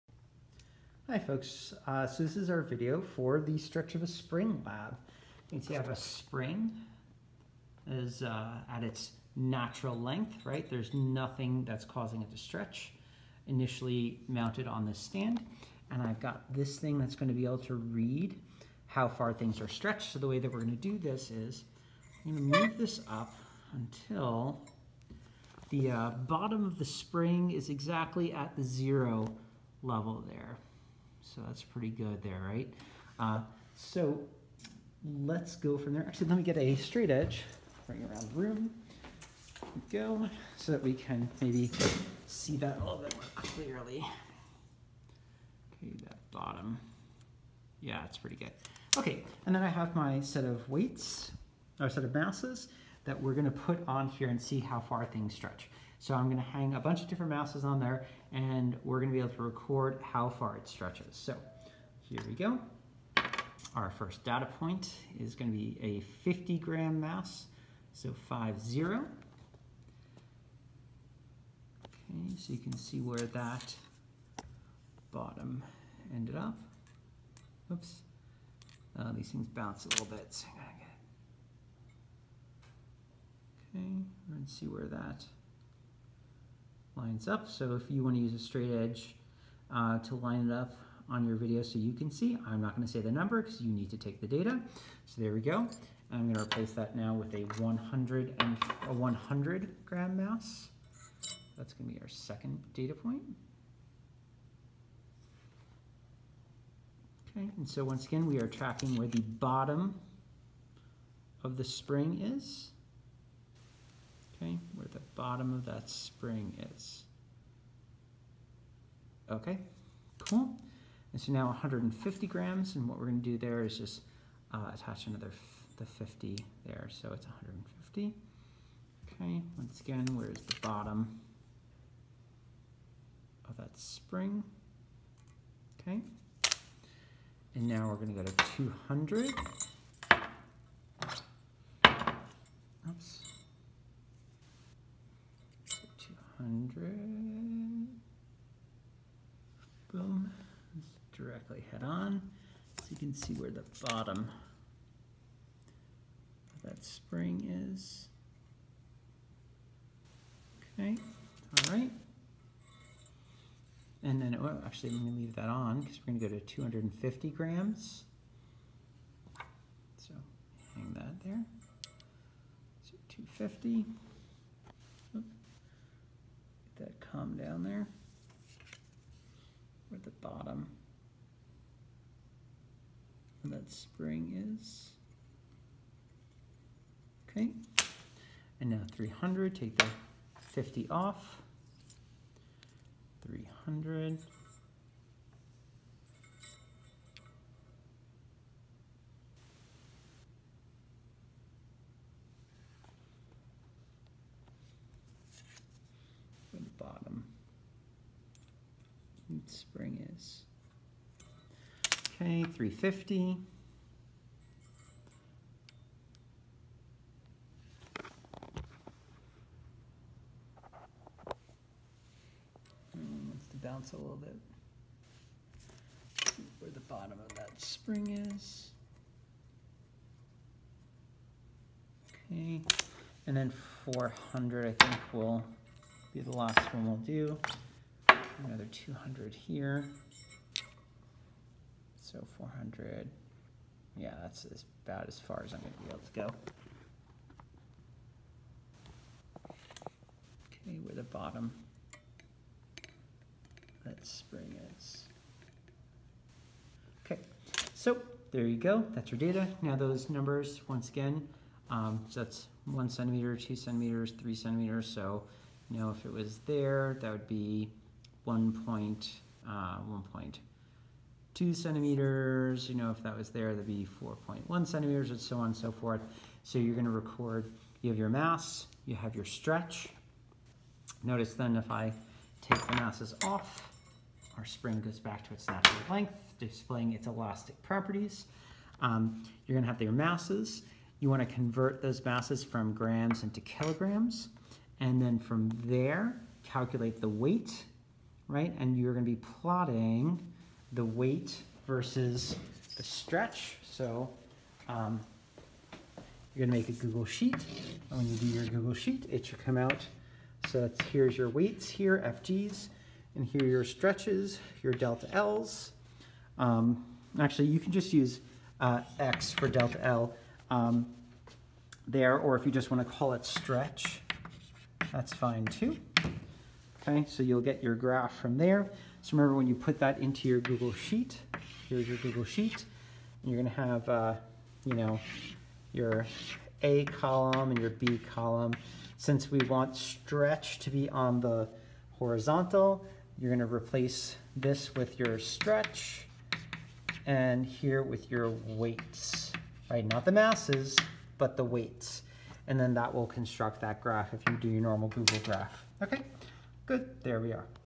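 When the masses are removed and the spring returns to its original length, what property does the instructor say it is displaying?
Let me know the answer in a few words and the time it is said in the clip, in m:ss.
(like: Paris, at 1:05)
elastic properties, at 4:47.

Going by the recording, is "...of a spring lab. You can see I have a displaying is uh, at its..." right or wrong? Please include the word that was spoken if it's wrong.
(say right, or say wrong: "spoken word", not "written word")
wrong: "spring", not "displaying".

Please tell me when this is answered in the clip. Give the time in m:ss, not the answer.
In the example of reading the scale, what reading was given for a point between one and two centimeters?
4:29.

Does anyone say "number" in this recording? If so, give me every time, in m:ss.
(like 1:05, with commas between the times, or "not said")
1:33, 4:20.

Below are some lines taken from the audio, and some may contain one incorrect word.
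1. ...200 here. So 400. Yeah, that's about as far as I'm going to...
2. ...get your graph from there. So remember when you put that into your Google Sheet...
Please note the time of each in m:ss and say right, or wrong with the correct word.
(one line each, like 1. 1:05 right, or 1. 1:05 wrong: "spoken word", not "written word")
1. 3:58 right
2. 5:27 right.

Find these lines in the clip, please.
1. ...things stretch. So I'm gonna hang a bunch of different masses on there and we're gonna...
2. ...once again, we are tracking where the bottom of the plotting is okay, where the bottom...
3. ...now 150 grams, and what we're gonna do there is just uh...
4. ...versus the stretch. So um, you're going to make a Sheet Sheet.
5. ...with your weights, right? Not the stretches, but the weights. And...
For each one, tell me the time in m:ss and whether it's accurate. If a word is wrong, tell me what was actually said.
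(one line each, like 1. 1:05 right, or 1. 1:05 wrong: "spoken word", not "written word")
1. 0:55 right
2. 1:47 wrong: "spring", not "plotting"
3. 2:01 right
4. 5:01 wrong: "Google", not "Sheet"
5. 5:47 wrong: "masses", not "stretches".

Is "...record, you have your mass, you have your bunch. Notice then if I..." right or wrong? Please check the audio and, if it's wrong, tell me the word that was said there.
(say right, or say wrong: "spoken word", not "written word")
wrong: "stretch", not "bunch".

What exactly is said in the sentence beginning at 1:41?
That's going to be our second data point.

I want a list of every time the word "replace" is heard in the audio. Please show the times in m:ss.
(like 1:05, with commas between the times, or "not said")
1:36, 5:43.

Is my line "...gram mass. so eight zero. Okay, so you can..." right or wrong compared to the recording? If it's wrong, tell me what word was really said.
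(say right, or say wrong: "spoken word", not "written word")
wrong: "five", not "eight".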